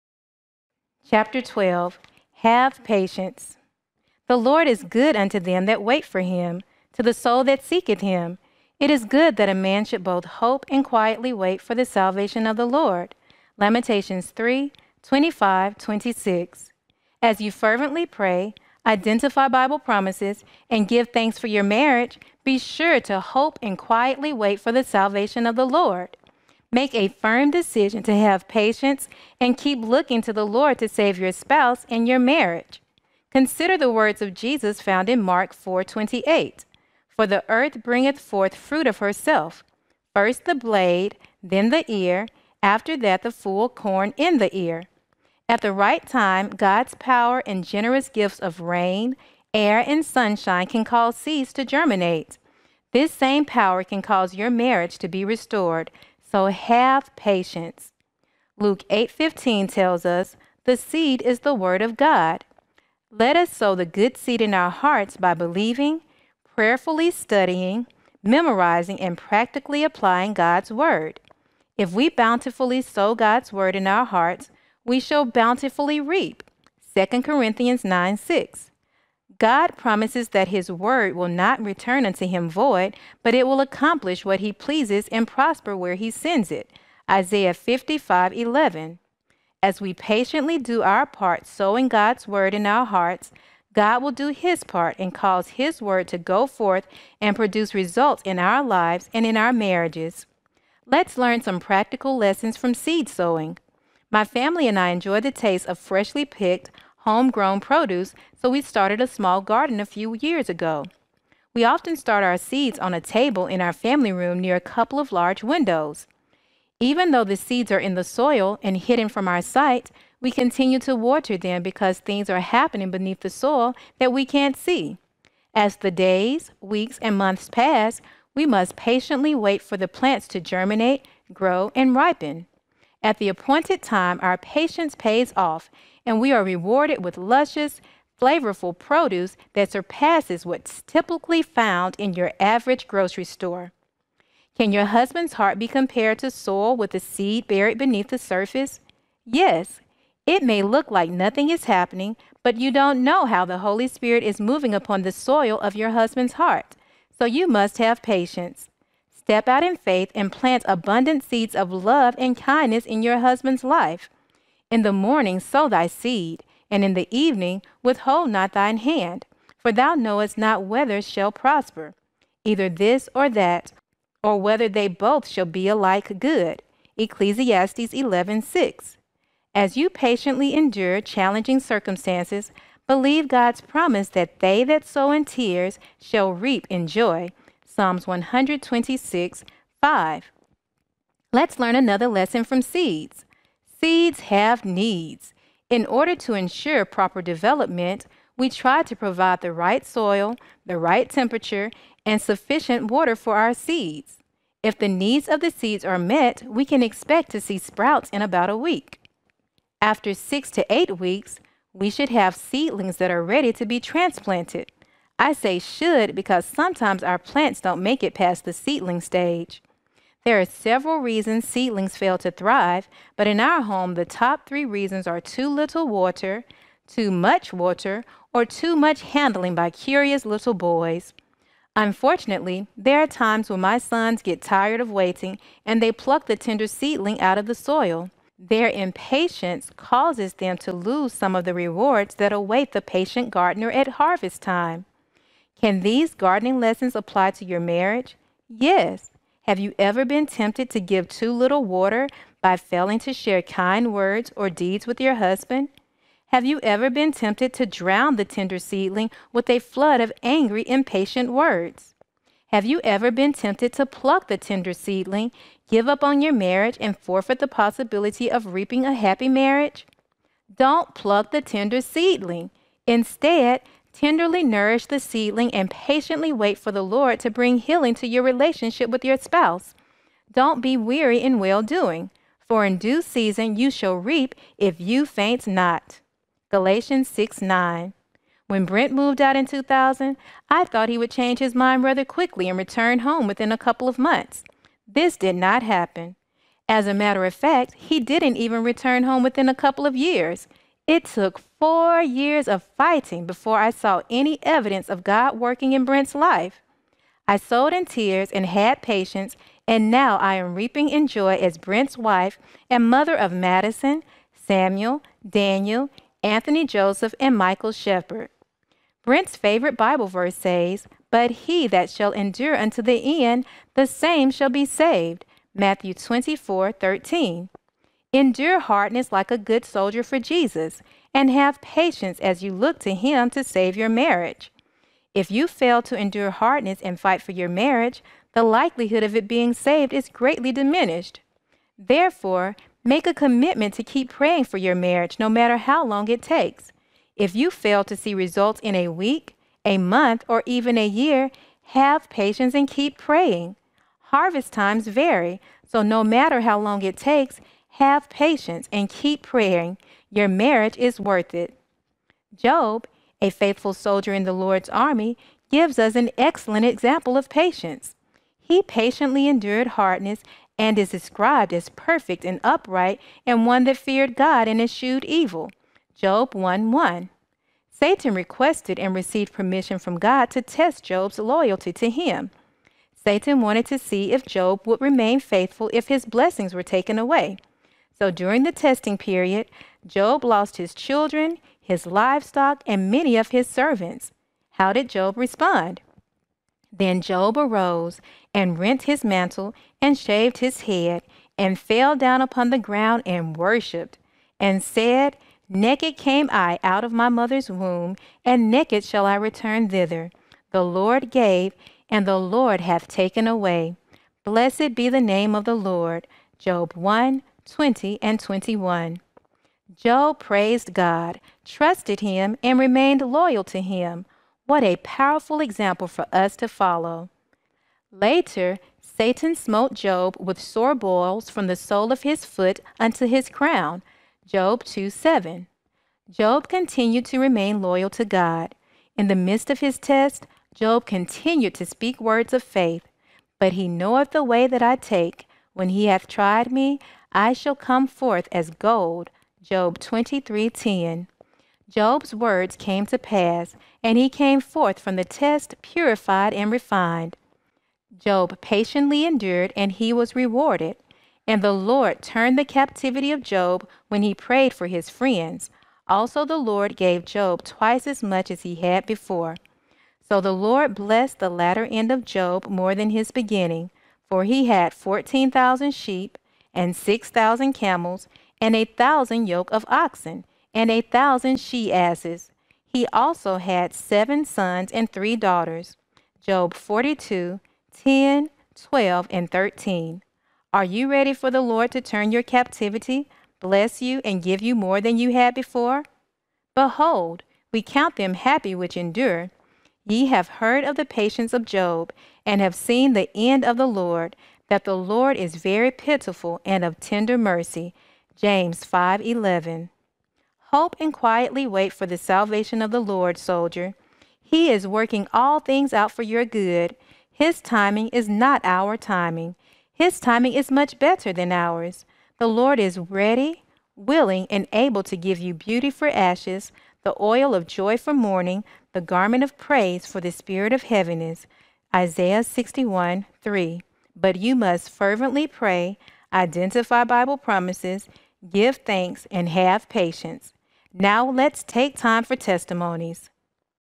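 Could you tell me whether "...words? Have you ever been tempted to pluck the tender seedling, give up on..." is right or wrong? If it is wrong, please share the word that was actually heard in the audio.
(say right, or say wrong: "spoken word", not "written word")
right.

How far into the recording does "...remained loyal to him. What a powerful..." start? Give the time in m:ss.
7:02.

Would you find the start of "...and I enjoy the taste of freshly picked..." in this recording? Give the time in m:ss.
1:44.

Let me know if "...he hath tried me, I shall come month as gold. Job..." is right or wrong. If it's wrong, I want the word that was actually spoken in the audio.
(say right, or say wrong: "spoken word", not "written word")
wrong: "forth", not "month".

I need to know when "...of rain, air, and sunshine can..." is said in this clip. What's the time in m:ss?
0:48.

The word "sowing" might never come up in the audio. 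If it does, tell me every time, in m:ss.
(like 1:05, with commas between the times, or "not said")
1:31, 1:43.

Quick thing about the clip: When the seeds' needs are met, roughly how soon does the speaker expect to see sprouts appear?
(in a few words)
about a week.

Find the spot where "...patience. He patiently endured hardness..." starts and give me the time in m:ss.
6:07.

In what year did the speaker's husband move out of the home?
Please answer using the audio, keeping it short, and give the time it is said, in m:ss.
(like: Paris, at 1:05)
2000, at 4:49.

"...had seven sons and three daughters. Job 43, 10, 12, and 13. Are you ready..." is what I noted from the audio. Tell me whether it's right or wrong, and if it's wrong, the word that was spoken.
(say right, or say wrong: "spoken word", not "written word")
wrong: "42", not "43".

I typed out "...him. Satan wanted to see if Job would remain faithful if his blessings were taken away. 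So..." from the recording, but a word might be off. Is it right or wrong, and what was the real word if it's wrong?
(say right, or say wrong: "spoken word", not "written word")
right.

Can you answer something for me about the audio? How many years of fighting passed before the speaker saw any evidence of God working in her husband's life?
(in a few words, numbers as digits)
4.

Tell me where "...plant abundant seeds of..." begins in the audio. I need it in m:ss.
2:40.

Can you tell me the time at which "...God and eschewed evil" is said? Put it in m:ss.
6:14.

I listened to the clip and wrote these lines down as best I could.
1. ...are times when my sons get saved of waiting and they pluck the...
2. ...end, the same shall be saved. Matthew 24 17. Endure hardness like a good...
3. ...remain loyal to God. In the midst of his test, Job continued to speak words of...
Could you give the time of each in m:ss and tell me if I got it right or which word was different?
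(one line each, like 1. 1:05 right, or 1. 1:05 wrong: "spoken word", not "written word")
1. 3:53 wrong: "tired", not "saved"
2. 5:23 wrong: "13", not "17"
3. 7:17 right.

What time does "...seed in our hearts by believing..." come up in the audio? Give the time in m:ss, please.
1:04.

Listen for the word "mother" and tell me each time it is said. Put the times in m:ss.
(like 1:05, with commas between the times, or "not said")
5:12, 6:47.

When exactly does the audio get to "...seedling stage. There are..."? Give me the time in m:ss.
3:38.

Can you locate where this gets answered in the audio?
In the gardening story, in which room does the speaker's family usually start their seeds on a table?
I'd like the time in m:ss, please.
1:53.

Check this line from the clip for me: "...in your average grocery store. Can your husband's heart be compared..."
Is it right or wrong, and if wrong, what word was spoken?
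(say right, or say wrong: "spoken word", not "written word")
right.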